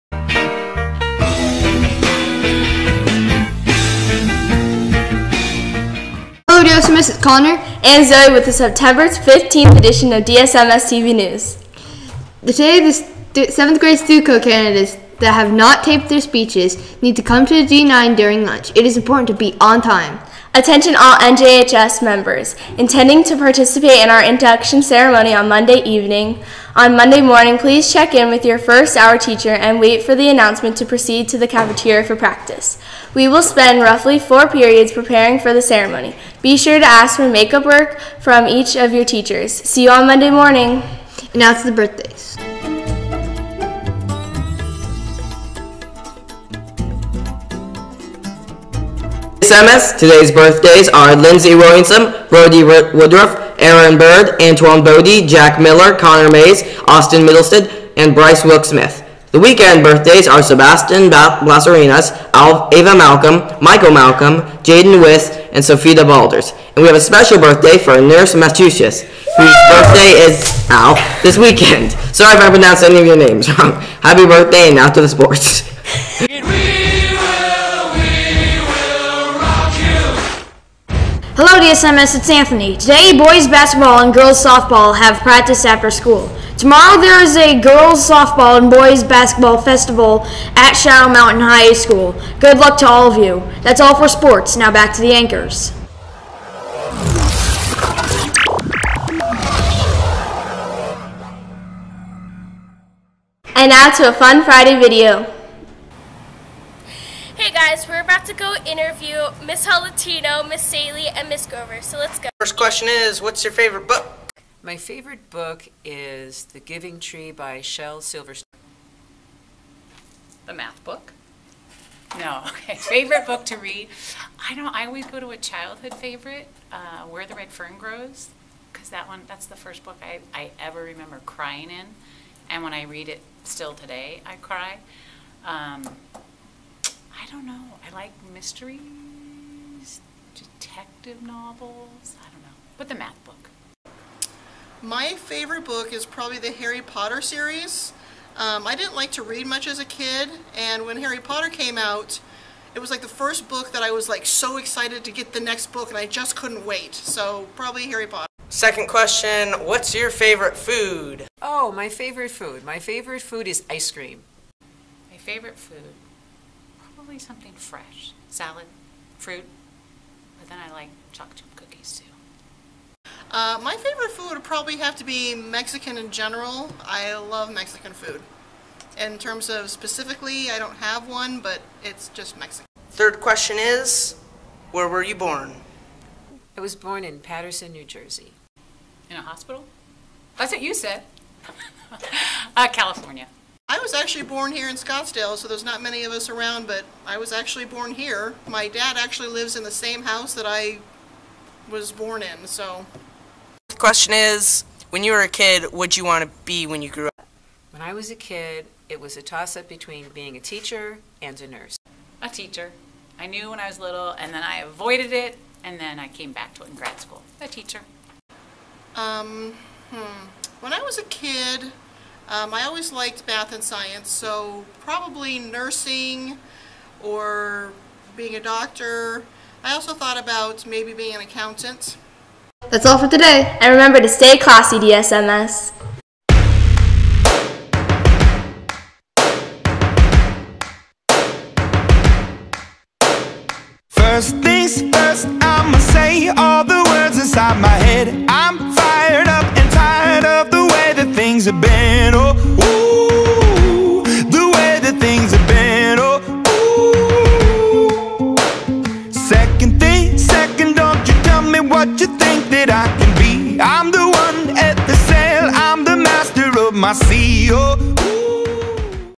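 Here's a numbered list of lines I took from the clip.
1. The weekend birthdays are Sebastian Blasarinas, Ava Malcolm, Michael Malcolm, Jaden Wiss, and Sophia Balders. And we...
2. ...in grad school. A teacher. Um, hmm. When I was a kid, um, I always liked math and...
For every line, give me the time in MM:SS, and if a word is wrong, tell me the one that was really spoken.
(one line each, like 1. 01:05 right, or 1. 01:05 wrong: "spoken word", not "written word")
1. 00:59 right
2. 03:36 right.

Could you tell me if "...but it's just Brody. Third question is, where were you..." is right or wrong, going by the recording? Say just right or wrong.
wrong.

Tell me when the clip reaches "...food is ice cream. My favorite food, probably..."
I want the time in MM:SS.
02:43.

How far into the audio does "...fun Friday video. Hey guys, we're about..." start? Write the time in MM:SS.
01:44.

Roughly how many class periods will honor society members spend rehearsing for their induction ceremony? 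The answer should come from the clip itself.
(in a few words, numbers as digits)
4.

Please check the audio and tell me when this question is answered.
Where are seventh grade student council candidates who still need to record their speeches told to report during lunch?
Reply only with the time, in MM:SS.
00:17.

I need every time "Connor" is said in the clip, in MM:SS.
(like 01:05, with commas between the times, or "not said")
00:07, 00:55.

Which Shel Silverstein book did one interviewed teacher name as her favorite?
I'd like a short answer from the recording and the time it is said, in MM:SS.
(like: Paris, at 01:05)
The Giving Tree, at 01:56.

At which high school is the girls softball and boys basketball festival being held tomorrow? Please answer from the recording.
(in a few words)
Shadow Mountain High School.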